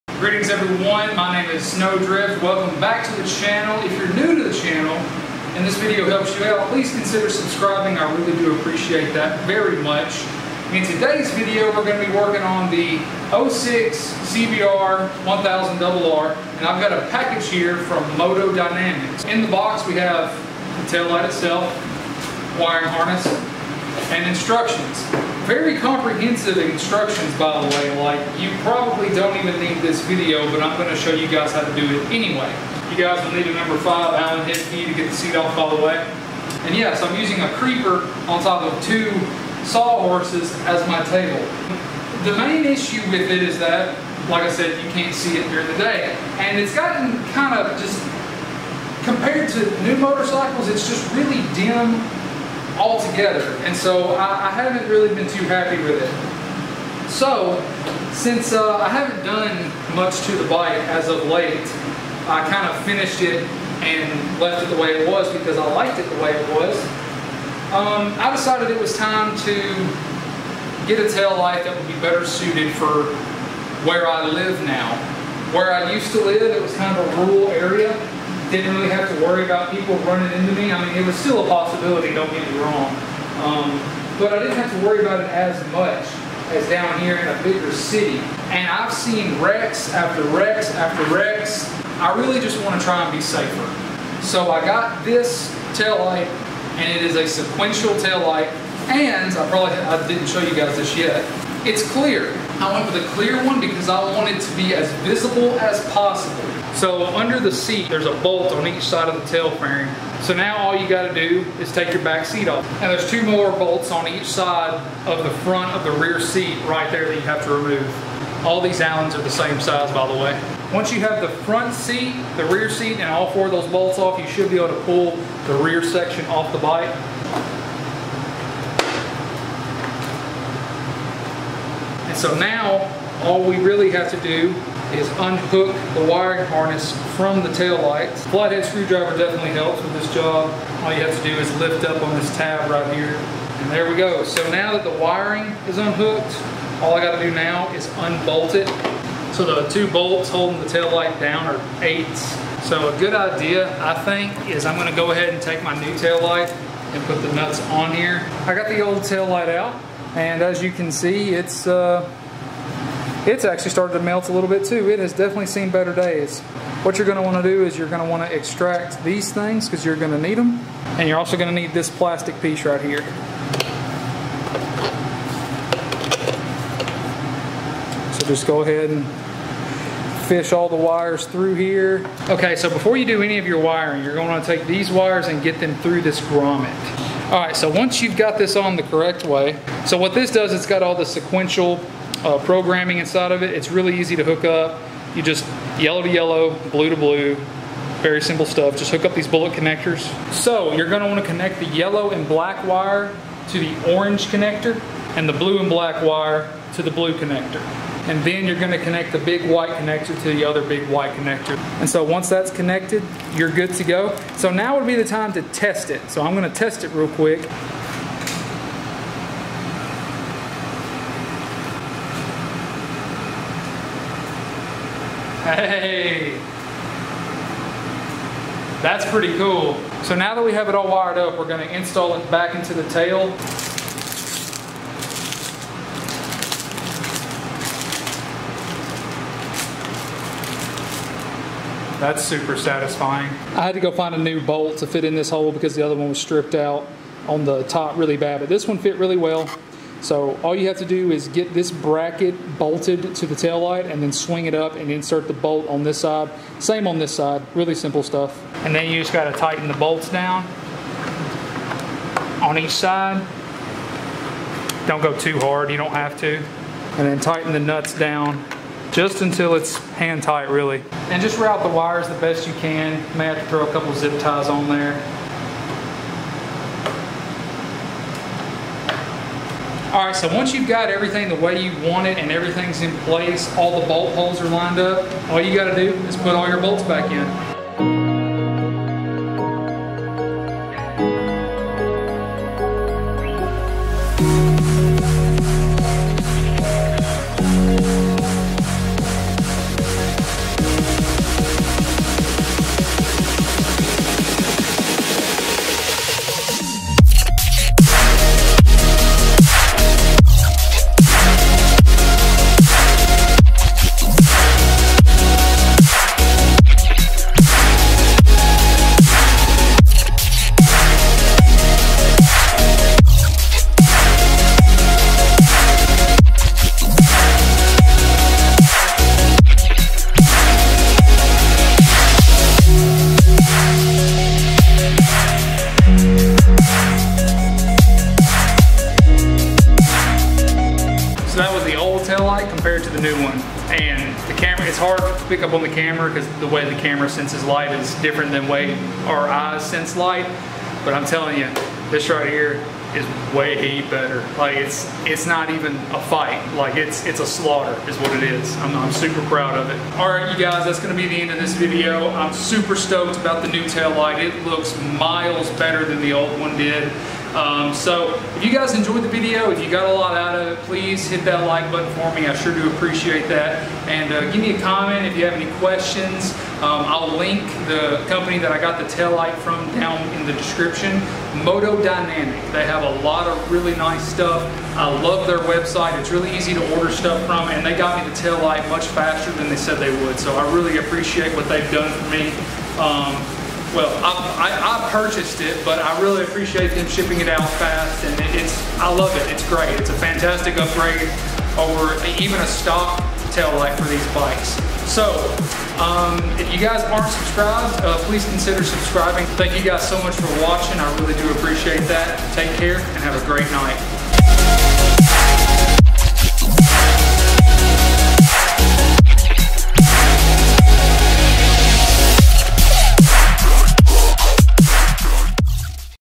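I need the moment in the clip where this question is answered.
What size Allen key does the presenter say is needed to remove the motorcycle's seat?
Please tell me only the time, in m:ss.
0:33.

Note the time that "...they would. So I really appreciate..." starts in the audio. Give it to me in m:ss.
6:29.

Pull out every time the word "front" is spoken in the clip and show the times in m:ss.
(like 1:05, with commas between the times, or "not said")
1:55, 2:01.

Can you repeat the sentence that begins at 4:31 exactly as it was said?
And just route the wires the best you can.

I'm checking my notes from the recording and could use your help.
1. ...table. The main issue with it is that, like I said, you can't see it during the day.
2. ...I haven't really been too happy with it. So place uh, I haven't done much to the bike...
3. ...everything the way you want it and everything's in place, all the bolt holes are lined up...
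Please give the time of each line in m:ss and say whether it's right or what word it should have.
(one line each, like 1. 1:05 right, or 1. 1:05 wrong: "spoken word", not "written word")
1. 0:41 right
2. 0:54 wrong: "since", not "place"
3. 4:40 right.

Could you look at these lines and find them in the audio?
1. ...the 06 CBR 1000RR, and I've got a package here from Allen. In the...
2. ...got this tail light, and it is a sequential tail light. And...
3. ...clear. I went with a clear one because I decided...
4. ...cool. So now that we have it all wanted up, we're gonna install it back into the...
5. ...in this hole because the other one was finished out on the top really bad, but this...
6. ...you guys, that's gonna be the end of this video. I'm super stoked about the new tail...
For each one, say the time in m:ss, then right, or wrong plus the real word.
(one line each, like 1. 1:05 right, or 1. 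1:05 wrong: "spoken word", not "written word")
1. 0:12 wrong: "Motodynamics", not "Allen"
2. 1:34 right
3. 1:41 wrong: "wanted", not "decided"
4. 3:49 wrong: "wired", not "wanted"
5. 4:05 wrong: "stripped", not "finished"
6. 6:00 right.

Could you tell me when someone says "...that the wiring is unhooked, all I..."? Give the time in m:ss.
2:24.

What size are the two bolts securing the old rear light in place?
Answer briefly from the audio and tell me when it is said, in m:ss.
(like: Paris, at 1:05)
8, at 2:31.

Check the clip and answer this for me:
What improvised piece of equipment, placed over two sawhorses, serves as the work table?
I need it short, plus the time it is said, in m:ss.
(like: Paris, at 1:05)
a creeper, at 0:37.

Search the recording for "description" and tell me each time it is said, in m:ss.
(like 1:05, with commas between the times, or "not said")
6:20.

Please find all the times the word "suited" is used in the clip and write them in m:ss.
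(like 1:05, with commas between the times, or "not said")
1:12.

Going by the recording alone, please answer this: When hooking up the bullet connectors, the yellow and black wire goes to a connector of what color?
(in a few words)
orange.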